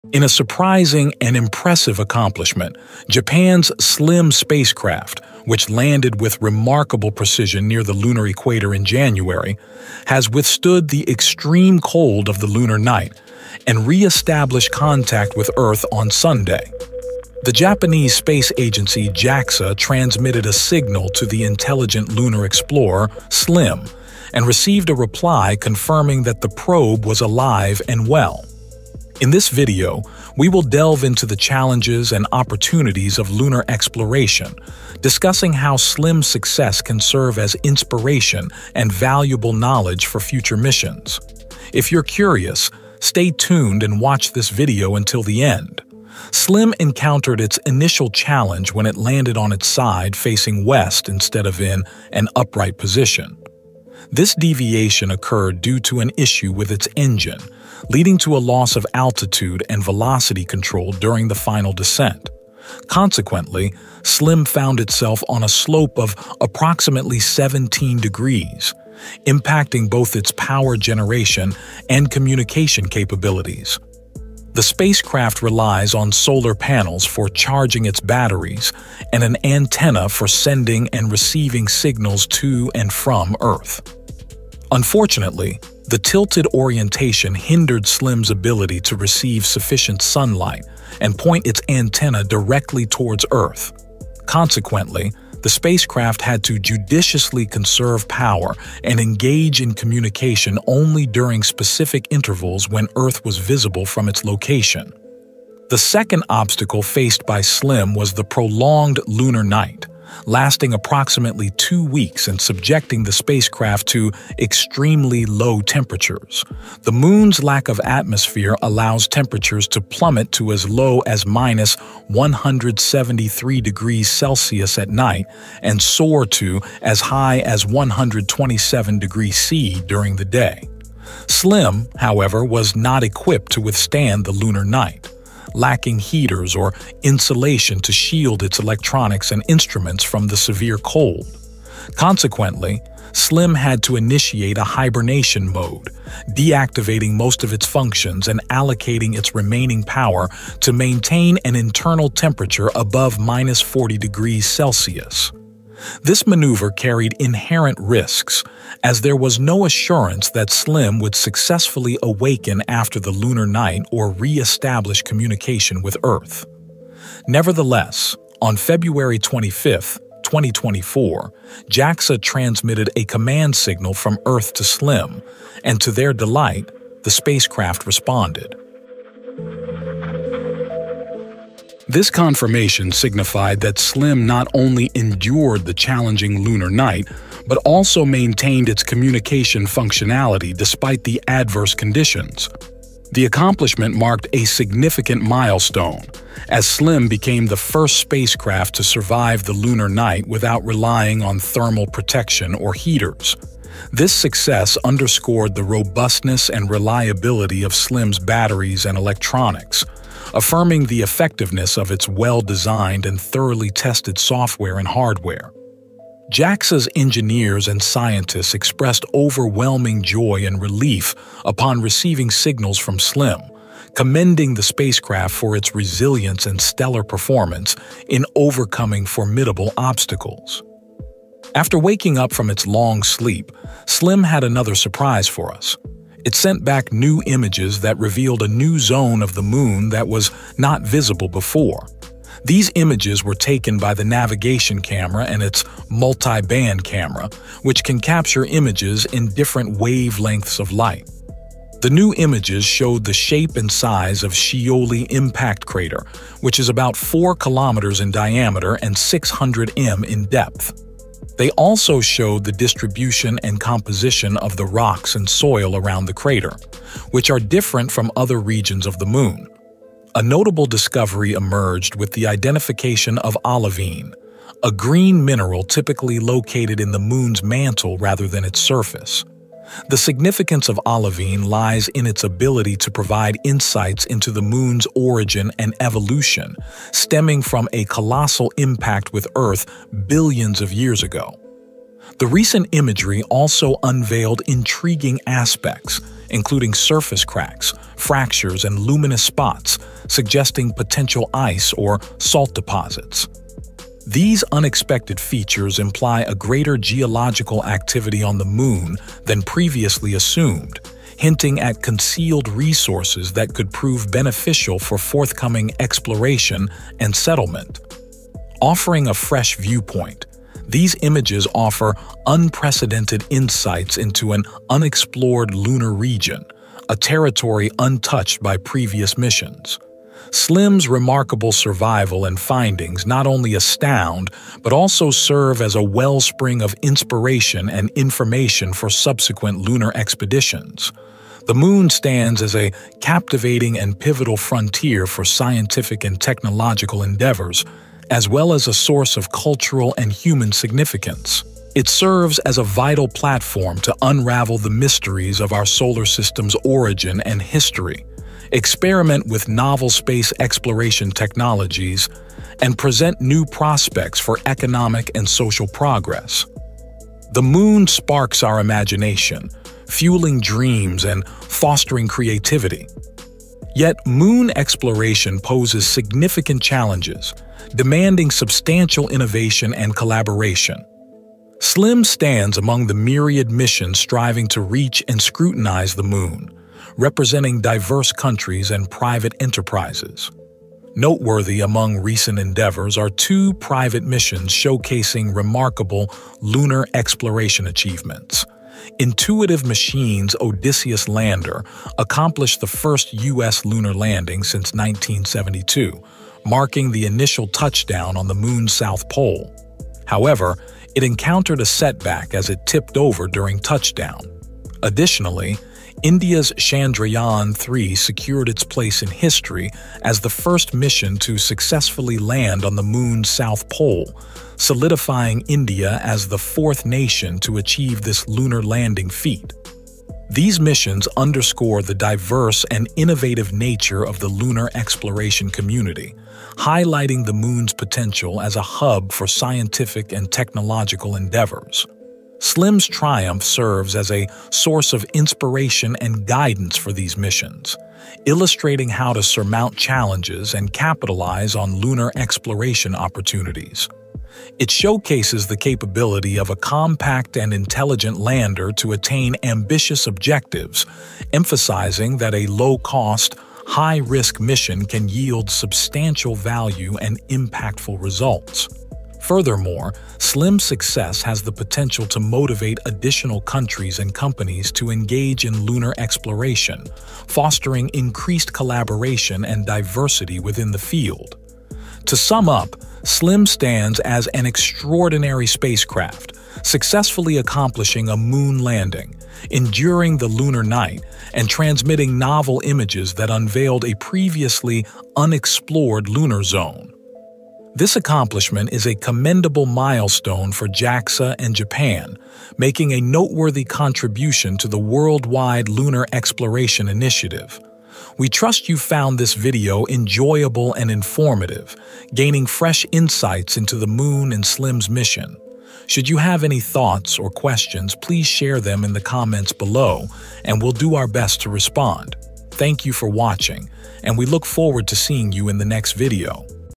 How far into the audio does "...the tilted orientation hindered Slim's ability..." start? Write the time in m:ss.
1:25.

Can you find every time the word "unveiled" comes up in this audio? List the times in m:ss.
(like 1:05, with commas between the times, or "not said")
4:53, 8:13.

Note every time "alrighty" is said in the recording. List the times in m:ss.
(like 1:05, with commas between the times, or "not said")
not said.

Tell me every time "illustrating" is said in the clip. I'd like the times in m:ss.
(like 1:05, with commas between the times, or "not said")
7:28.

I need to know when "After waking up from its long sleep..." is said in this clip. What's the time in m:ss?
3:51.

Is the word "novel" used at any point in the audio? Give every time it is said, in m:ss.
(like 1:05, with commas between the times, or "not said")
5:59, 8:12.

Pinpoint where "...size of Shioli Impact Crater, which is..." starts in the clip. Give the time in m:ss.
4:13.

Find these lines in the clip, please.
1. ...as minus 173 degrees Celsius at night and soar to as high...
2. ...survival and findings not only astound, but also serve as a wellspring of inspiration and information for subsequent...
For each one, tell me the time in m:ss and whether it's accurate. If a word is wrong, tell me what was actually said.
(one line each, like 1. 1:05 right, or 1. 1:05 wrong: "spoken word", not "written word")
1. 2:01 right
2. 5:31 right.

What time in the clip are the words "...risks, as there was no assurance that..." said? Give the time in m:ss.
2:37.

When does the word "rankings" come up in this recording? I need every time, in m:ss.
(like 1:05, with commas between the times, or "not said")
not said.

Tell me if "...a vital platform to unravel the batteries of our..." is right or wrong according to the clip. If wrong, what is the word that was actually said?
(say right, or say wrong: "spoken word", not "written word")
wrong: "mysteries", not "batteries".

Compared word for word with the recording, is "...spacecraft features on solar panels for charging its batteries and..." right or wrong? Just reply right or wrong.
wrong.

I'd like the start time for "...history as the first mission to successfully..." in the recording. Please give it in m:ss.
6:59.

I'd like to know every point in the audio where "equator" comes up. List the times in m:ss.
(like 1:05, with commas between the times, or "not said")
0:08.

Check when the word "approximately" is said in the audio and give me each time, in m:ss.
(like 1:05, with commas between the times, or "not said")
1:06, 1:50.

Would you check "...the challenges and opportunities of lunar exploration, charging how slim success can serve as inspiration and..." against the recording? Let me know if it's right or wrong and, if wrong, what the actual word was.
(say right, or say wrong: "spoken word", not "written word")
wrong: "discussing", not "charging".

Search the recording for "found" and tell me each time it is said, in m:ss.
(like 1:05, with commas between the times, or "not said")
1:04, 8:28.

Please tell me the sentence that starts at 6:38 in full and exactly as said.
Intuitive Machines' Odysseus lander accomplished the first U.S.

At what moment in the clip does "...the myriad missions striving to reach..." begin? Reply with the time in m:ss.
6:22.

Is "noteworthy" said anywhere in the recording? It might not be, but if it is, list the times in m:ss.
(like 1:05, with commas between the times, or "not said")
6:30, 8:22.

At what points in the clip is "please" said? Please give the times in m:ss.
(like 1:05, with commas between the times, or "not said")
8:37.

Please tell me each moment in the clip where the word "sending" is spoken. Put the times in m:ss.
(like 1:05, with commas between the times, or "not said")
1:20.